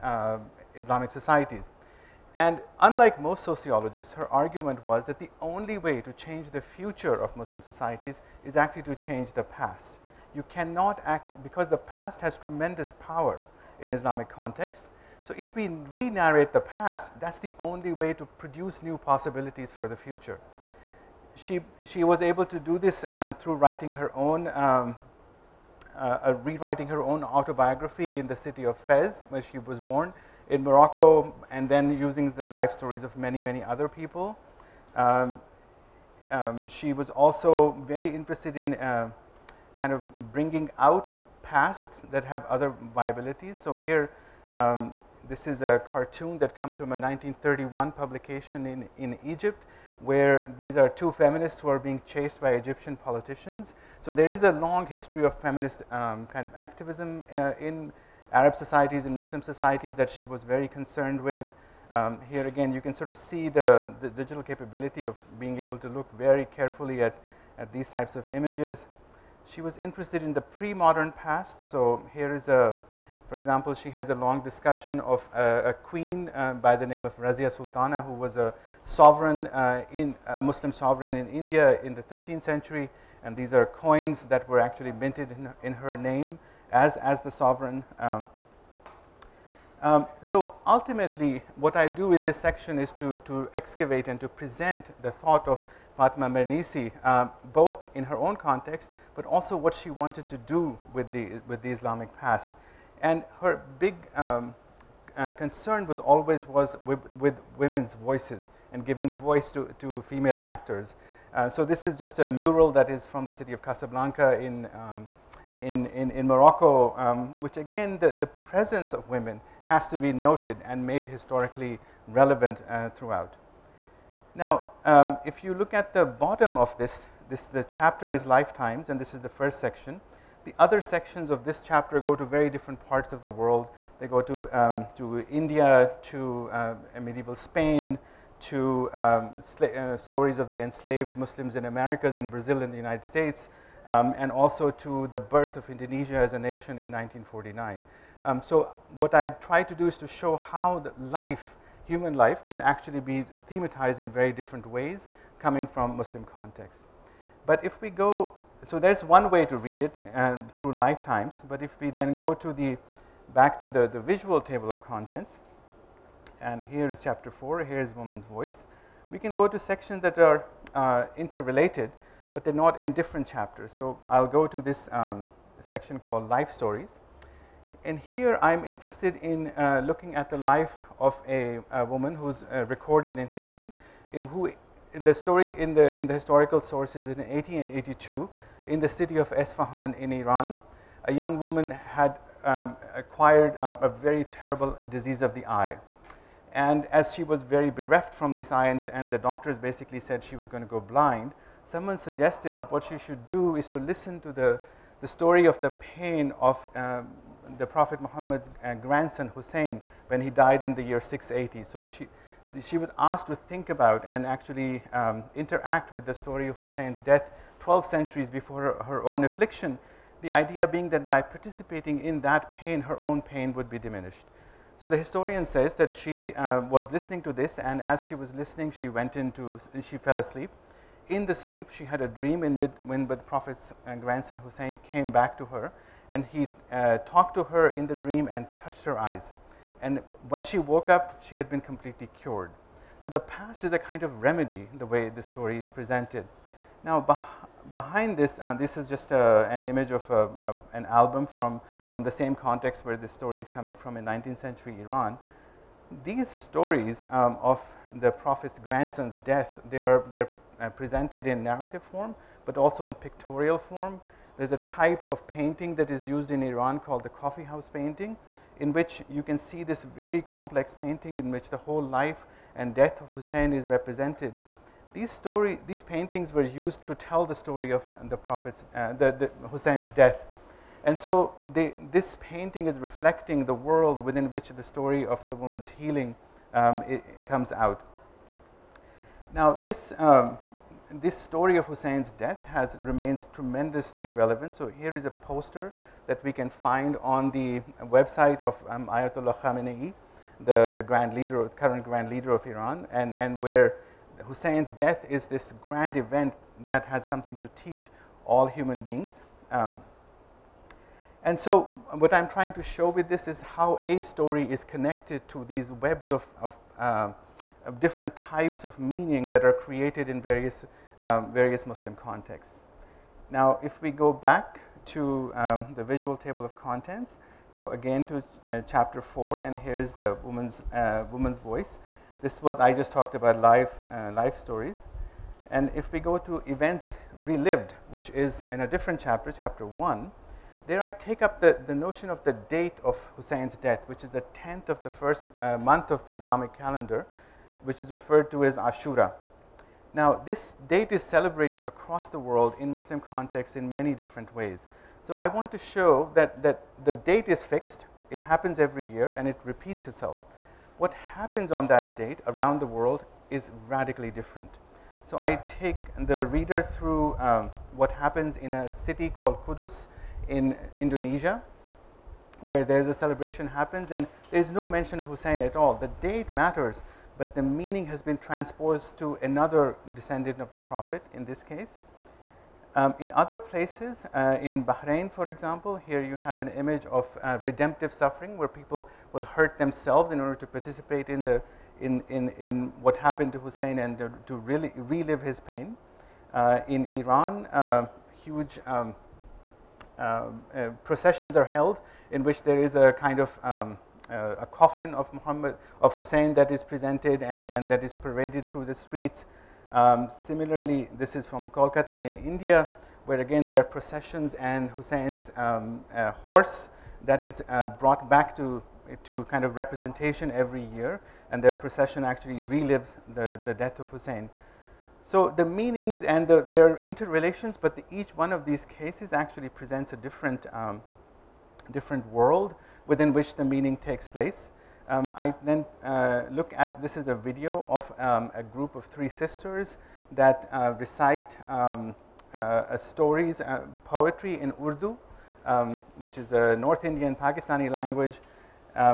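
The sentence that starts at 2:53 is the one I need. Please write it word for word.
So I'll go to this um, section called life stories.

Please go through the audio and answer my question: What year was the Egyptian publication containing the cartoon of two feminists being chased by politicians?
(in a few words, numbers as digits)
1931.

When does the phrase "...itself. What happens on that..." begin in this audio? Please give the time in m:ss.
5:59.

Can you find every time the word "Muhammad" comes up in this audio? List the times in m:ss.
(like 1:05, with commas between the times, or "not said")
3:28, 6:45.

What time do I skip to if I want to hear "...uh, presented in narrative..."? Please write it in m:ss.
4:20.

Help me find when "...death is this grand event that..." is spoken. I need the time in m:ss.
5:04.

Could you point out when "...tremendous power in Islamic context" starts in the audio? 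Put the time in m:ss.
0:12.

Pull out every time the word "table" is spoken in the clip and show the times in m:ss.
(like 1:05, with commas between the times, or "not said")
2:44, 5:26.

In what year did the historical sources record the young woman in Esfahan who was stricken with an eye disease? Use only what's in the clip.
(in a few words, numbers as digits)
1882.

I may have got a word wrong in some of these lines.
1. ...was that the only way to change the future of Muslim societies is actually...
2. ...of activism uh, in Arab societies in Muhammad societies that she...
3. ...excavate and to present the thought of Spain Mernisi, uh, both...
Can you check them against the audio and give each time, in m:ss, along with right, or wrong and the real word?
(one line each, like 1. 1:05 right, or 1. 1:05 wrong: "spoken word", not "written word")
1. 0:04 right
2. 0:56 wrong: "Muslim", not "Muhammad"
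3. 1:33 wrong: "Fatima", not "Spain".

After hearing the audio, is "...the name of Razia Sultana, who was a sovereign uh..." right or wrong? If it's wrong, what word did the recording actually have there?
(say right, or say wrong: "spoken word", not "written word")
right.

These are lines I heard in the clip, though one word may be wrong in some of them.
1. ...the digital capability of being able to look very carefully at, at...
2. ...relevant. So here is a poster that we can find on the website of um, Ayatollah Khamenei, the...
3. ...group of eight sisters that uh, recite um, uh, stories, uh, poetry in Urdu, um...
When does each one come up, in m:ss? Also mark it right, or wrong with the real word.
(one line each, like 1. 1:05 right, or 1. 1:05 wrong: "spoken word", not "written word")
1. 1:04 right
2. 4:54 right
3. 7:18 wrong: "three", not "eight".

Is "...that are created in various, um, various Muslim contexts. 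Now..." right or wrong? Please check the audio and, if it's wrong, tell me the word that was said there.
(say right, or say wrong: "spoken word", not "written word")
right.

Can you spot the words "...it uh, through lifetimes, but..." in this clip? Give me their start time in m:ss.
2:39.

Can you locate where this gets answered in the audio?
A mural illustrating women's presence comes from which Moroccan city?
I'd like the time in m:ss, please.
1:53.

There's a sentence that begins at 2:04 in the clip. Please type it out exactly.
Now, um, if you look at the bottom of this, this, the chapter is lifetimes and this is the first section.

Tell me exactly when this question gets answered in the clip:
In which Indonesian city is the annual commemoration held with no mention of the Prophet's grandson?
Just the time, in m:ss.
6:09.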